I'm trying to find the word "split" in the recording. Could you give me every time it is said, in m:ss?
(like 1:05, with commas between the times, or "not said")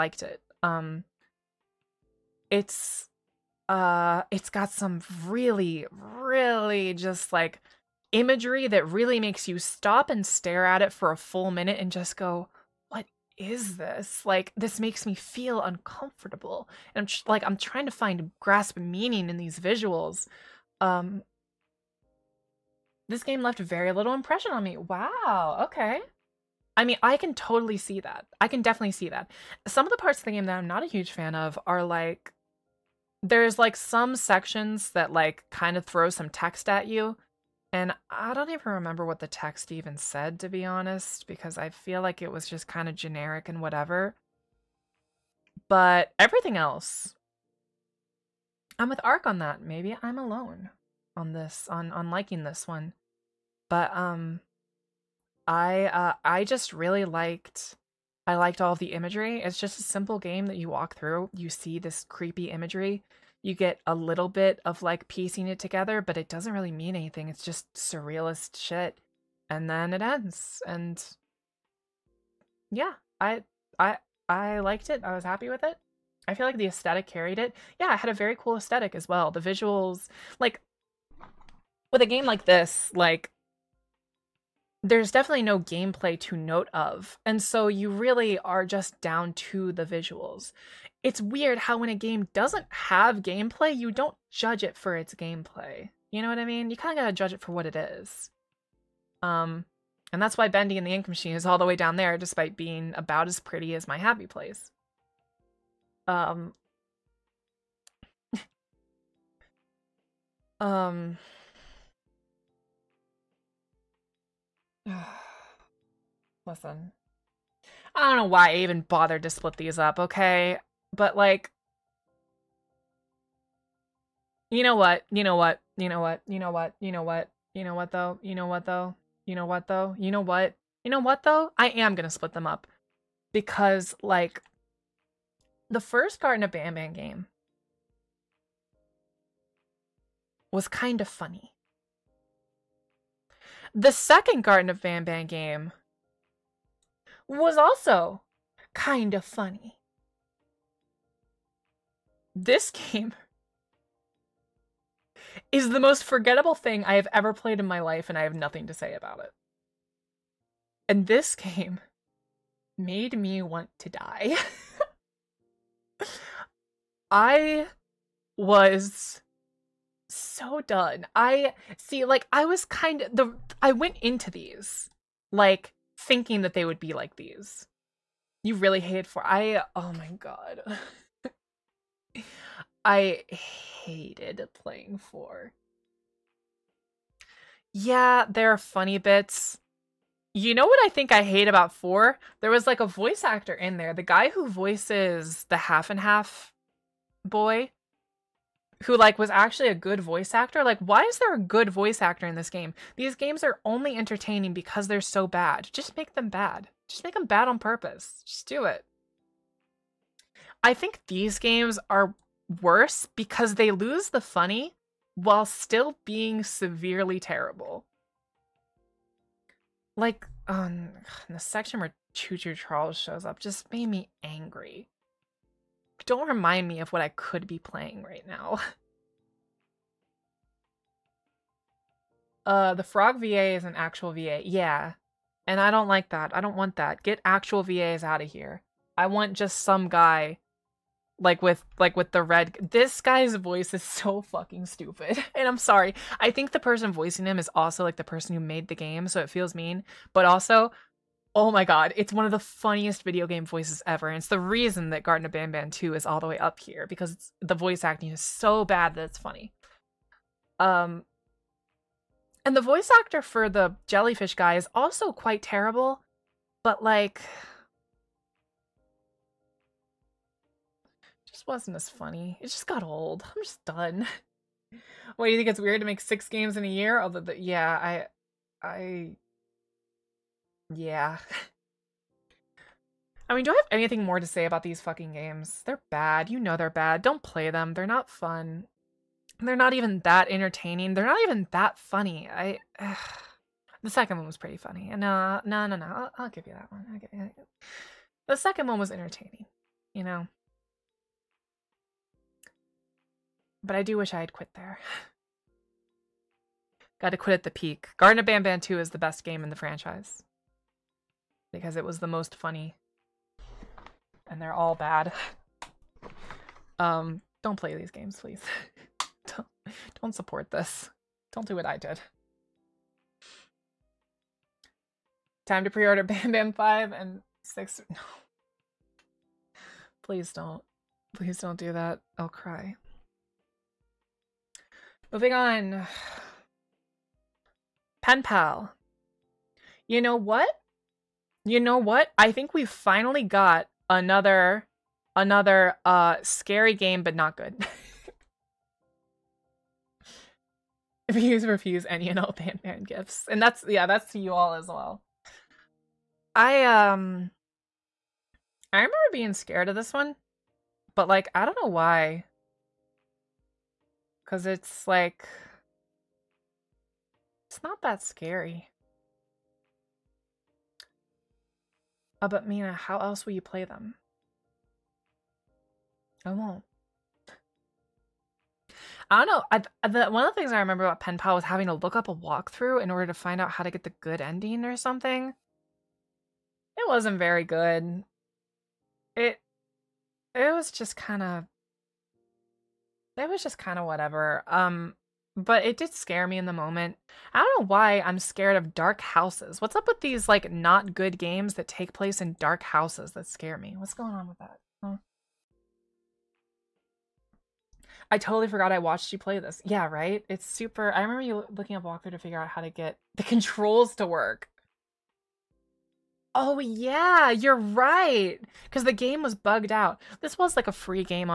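1:59, 2:12.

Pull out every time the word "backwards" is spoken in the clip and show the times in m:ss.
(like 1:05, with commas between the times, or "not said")
not said.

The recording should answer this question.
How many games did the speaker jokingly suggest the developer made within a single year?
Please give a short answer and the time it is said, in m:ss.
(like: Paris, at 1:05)
6, at 4:36.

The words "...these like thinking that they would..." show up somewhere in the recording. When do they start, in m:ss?
2:54.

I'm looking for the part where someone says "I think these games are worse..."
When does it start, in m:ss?
3:30.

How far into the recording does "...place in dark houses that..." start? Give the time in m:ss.
6:41.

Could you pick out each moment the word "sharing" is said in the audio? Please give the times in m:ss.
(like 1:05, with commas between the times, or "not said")
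not said.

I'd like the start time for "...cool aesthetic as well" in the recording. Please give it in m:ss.
1:18.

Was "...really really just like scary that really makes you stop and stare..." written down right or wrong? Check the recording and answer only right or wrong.
wrong.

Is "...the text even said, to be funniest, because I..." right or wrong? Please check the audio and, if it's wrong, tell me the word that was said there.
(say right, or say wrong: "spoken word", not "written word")
wrong: "honest", not "funniest".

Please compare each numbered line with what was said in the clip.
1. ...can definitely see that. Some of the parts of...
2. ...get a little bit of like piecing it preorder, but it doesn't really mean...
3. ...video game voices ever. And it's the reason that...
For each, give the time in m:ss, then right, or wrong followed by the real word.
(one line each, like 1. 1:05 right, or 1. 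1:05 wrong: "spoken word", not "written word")
1. 0:28 right
2. 1:03 wrong: "together", not "preorder"
3. 4:13 right.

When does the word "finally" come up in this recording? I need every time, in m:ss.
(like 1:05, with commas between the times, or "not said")
5:42.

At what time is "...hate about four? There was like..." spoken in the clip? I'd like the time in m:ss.
3:11.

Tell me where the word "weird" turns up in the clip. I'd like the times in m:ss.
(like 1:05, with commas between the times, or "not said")
1:31, 4:35.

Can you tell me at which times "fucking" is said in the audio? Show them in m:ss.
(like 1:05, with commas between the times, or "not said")
4:04, 4:44.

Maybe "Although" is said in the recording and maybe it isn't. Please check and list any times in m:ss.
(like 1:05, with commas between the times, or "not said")
4:37.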